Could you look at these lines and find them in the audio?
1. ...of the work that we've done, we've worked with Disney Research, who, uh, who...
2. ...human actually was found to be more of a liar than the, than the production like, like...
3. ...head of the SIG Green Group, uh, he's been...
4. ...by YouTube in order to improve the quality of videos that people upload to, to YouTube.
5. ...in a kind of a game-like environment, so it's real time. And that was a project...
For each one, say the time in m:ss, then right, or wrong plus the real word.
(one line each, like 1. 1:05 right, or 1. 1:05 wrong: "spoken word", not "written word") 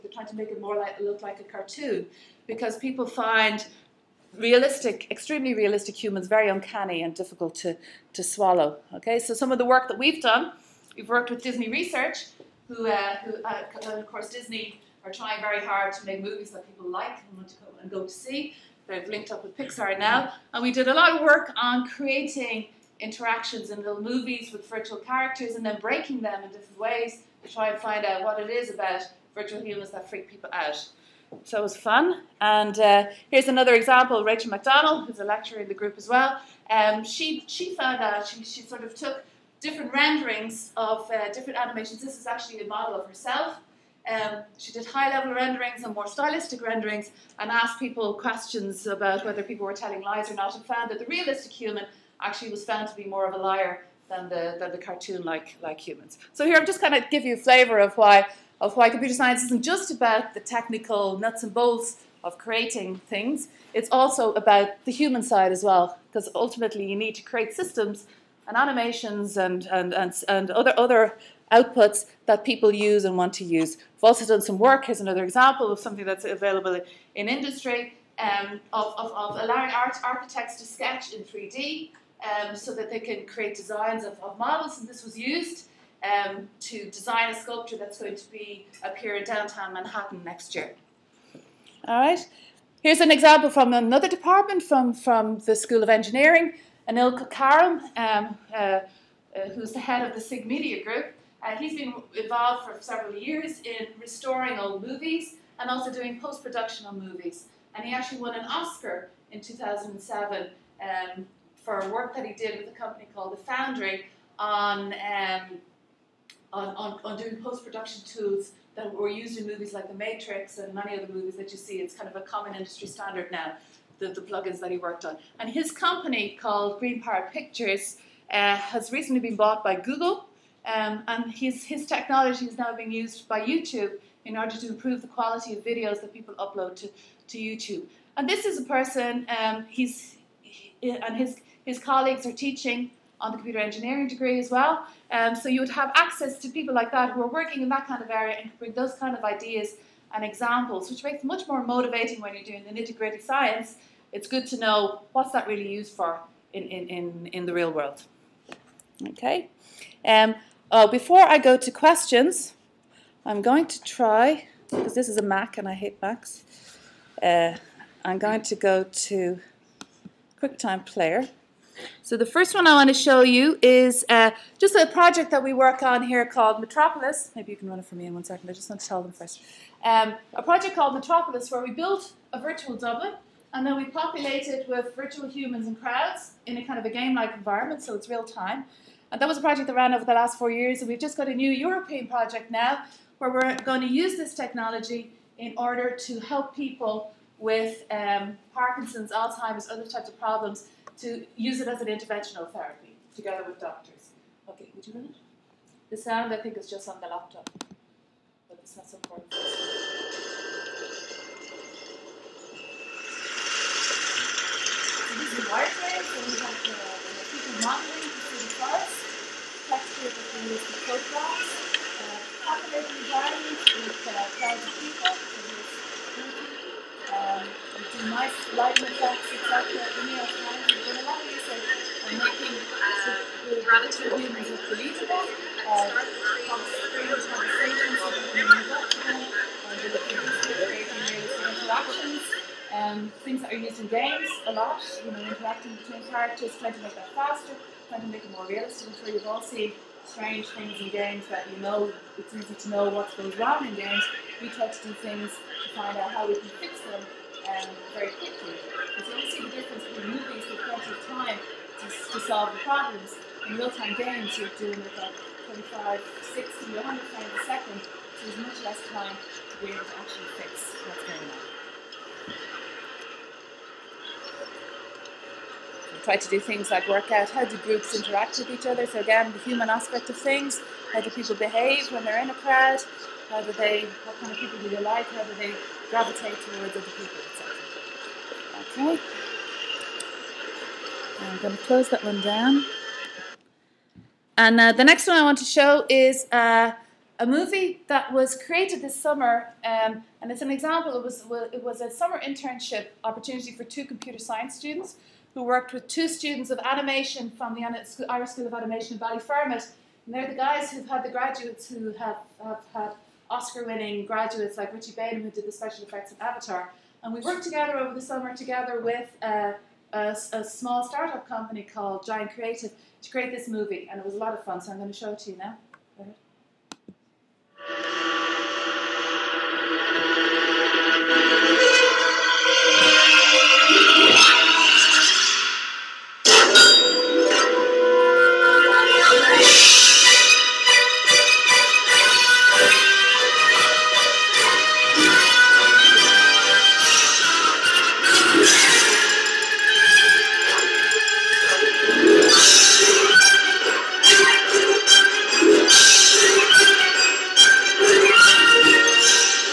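1. 0:09 right
2. 0:51 wrong: "cartoon", not "production"
3. 1:39 wrong: "Media", not "Green"
4. 2:13 right
5. 3:06 right.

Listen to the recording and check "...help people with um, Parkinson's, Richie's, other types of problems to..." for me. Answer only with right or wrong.
wrong.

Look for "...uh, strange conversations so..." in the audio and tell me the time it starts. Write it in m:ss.
3:55.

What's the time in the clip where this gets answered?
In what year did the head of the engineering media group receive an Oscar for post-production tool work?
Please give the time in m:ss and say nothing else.
1:49.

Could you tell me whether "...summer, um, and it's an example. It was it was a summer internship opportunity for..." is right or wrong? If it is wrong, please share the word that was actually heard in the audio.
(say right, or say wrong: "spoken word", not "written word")
right.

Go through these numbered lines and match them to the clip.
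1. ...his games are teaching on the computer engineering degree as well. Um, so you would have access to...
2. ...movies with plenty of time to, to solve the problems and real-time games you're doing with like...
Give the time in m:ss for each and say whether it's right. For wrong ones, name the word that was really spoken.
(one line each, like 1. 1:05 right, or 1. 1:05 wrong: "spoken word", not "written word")
1. 2:21 wrong: "colleagues", not "games"
2. 4:20 right.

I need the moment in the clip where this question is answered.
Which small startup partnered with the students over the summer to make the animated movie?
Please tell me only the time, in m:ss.
5:22.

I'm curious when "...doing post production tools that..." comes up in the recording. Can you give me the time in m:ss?
1:57.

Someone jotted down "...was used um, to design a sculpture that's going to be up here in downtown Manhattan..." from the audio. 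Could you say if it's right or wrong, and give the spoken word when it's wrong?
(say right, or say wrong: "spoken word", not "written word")
right.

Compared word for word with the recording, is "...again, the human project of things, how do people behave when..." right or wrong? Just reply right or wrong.
wrong.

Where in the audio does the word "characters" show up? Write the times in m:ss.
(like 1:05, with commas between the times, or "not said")
0:24, 4:06.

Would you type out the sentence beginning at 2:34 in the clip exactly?
It's good to know what's that really used for in, in, in, in the real world.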